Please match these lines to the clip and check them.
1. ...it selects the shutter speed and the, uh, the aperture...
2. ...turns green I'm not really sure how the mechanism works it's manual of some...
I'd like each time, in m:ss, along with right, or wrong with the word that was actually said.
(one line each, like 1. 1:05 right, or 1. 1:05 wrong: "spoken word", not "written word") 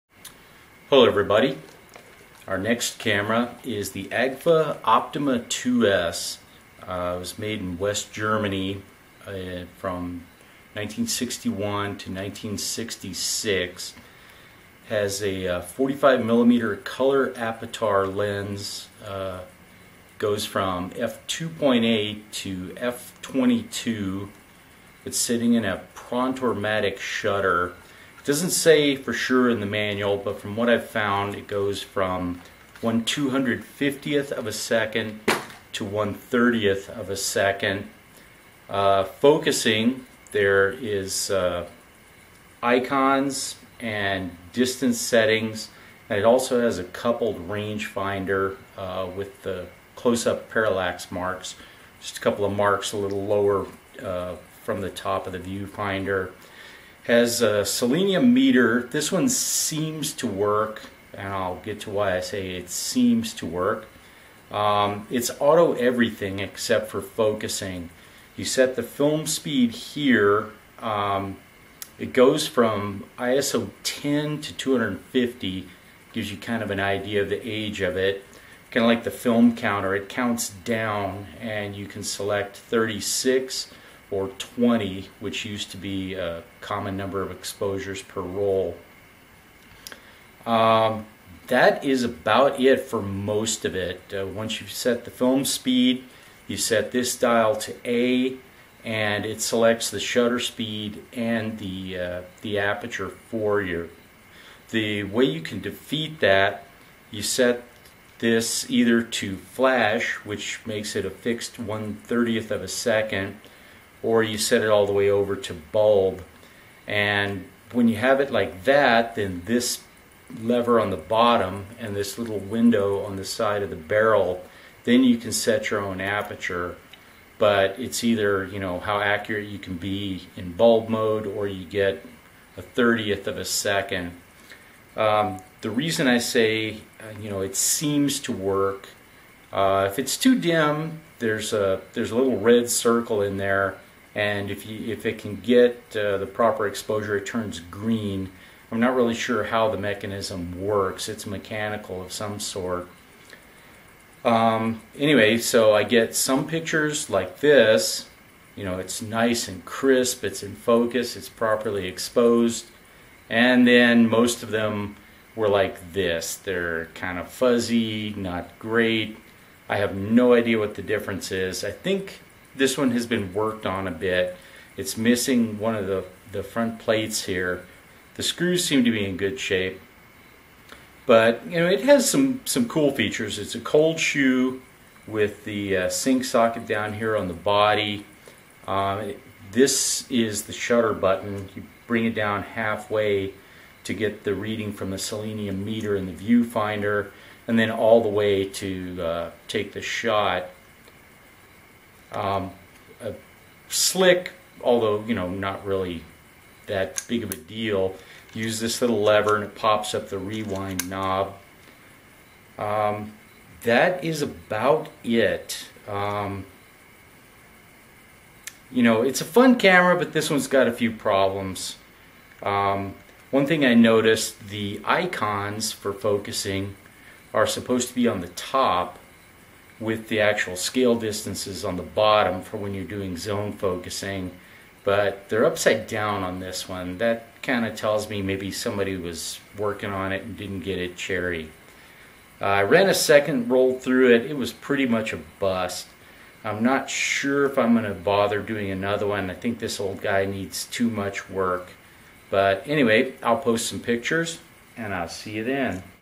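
1. 1:39 right
2. 2:27 wrong: "mechanical", not "manual".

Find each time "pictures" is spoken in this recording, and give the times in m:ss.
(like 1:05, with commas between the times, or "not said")
2:36, 4:13.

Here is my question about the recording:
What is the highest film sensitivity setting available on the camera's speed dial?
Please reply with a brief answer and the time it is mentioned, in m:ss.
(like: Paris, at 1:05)
ISO 250, at 1:14.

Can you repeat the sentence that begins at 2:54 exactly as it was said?
It's missing one of the, the front plates here.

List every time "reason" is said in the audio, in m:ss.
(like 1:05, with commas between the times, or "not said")
2:15.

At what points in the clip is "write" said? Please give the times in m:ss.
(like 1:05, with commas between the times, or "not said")
not said.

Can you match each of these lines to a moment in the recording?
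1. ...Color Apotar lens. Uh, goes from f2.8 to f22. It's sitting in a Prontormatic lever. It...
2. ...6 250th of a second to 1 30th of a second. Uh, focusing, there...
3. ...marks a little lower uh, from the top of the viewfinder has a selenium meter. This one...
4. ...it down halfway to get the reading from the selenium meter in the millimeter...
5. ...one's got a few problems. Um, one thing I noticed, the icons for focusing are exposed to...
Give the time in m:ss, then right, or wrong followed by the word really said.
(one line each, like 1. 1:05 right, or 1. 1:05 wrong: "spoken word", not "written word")
1. 0:16 wrong: "shutter", not "lever"
2. 0:32 wrong: "1", not "6"
3. 0:52 right
4. 3:12 wrong: "viewfinder", not "millimeter"
5. 3:40 wrong: "supposed", not "exposed".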